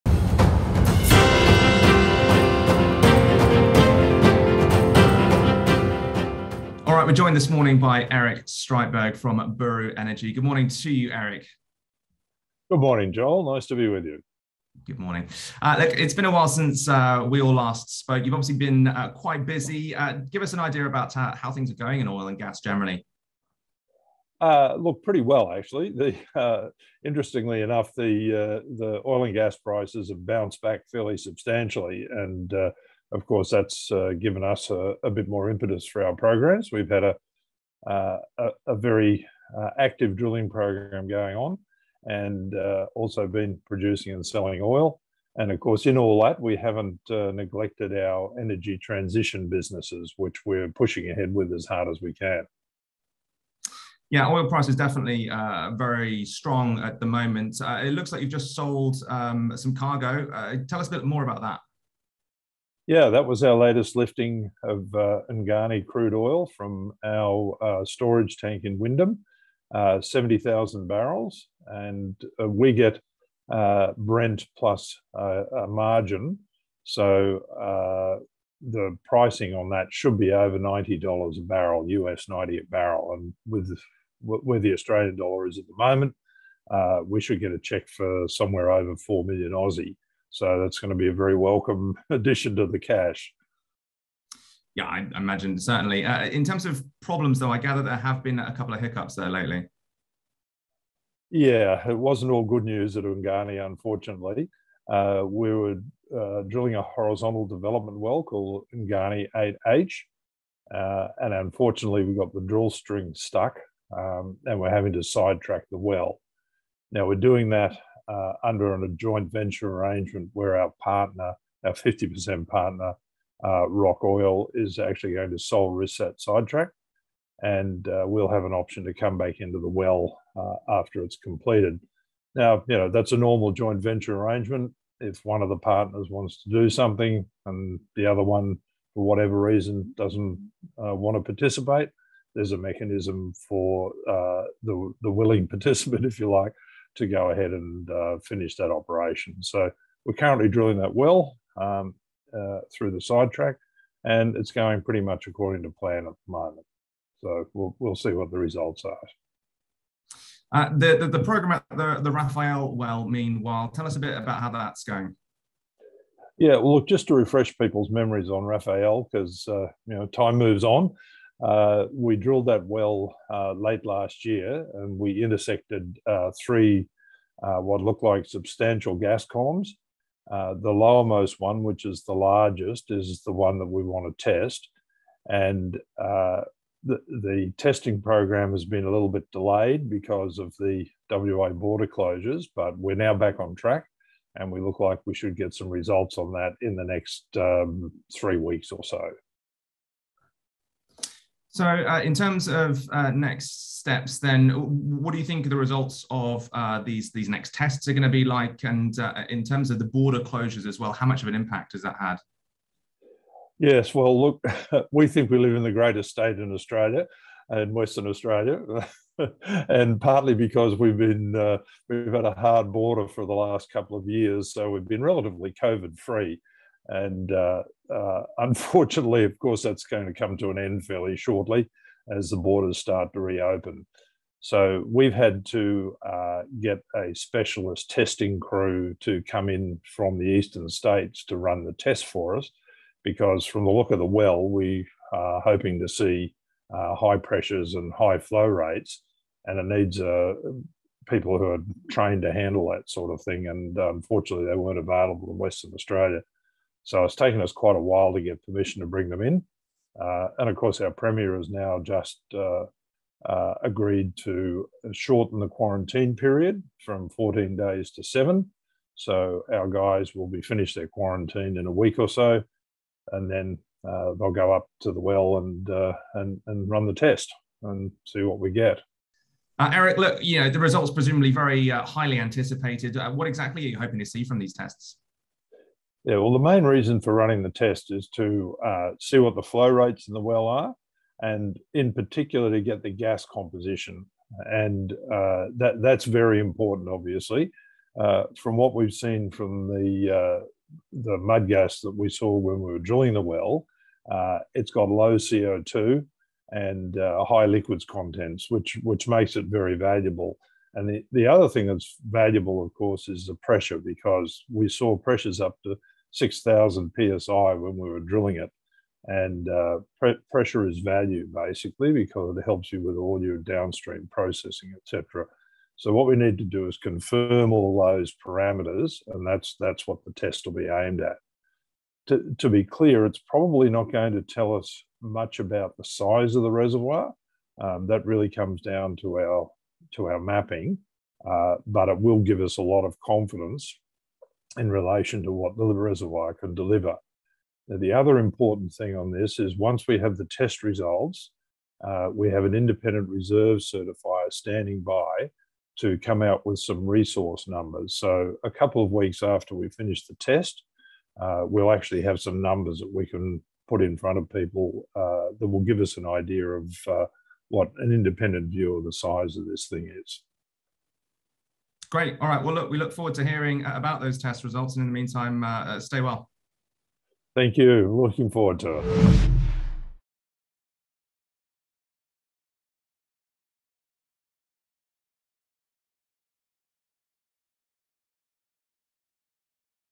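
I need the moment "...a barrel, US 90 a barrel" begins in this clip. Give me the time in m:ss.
1:21.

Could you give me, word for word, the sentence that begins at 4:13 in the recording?
And uh, unfortunately, they weren't available in Western Australia.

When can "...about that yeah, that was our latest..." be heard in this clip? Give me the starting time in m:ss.
1:01.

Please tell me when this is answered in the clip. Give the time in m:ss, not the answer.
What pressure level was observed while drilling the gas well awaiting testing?
5:16.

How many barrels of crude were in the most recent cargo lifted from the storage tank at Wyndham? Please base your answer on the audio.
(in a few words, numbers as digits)
70,000.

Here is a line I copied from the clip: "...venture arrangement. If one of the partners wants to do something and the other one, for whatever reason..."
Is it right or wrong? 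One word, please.
right.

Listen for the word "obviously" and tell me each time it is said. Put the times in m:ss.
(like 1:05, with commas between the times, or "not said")
0:18, 4:56.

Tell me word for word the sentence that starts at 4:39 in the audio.
Uh, Eric, look, you know the results presumably very highly anticipated.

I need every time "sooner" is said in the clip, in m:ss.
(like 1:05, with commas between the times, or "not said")
not said.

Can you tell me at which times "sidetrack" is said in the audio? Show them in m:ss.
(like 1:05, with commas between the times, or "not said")
1:55, 2:06, 2:33.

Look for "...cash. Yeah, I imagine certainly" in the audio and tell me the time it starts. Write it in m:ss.
1:32.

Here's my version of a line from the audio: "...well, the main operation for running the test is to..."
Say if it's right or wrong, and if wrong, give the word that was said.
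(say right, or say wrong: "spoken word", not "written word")
wrong: "reason", not "operation".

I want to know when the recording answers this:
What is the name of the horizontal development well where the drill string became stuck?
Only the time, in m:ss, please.
1:48.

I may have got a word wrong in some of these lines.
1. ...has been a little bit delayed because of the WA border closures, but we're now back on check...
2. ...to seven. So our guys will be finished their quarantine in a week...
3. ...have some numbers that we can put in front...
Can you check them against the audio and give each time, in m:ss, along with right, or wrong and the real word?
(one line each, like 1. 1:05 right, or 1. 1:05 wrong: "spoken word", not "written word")
1. 3:08 wrong: "track", not "check"
2. 4:27 right
3. 6:02 right.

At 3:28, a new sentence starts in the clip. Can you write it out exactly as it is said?
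And uh, in terms of the border closures as well, how much of an impact has that had?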